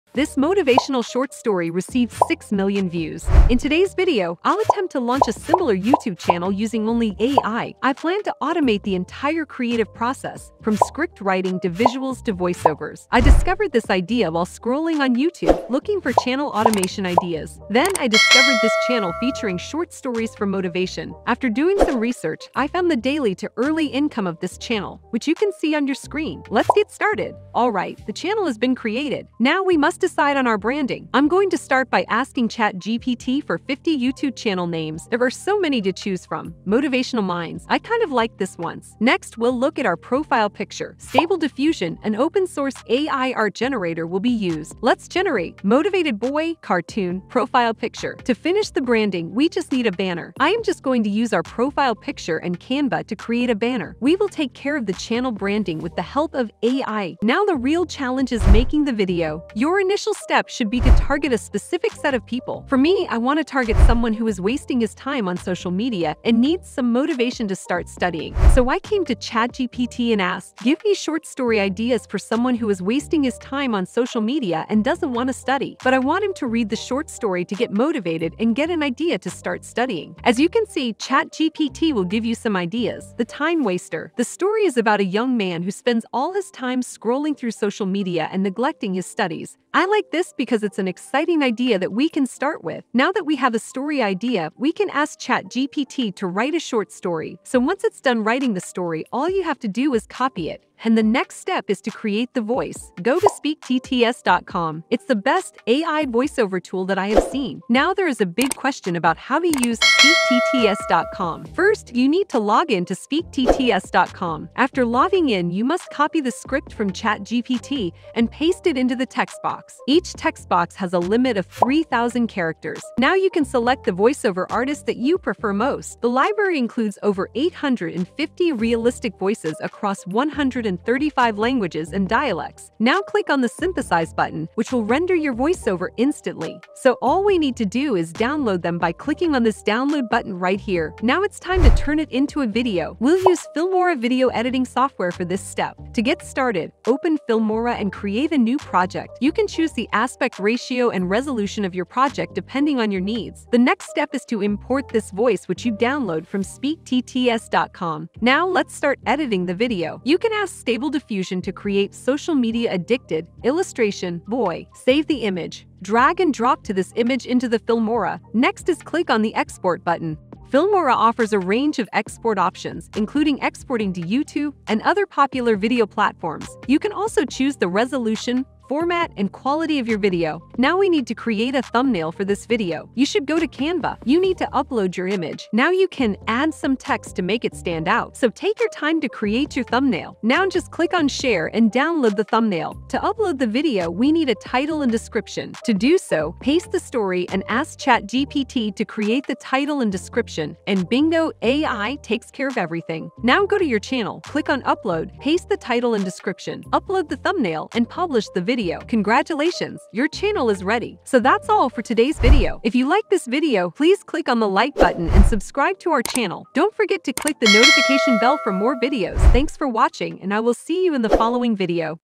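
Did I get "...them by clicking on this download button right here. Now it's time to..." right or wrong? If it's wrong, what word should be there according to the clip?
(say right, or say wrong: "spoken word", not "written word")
right.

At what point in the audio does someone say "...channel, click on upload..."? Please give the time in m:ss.
3:23.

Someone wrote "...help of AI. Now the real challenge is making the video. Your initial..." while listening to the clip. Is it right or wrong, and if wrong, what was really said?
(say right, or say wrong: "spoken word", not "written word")
right.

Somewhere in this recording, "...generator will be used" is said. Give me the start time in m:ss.
0:43.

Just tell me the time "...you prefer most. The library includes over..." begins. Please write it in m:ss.
2:04.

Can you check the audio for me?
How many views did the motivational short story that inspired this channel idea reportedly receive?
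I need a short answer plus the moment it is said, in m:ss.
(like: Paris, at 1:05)
6 million, at 0:02.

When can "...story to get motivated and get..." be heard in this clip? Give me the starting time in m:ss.
1:17.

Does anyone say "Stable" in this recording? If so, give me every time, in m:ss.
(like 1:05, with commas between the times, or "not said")
0:40, 2:40.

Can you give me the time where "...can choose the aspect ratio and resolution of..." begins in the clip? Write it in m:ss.
2:29.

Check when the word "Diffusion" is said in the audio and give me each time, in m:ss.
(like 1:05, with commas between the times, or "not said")
0:41, 2:40.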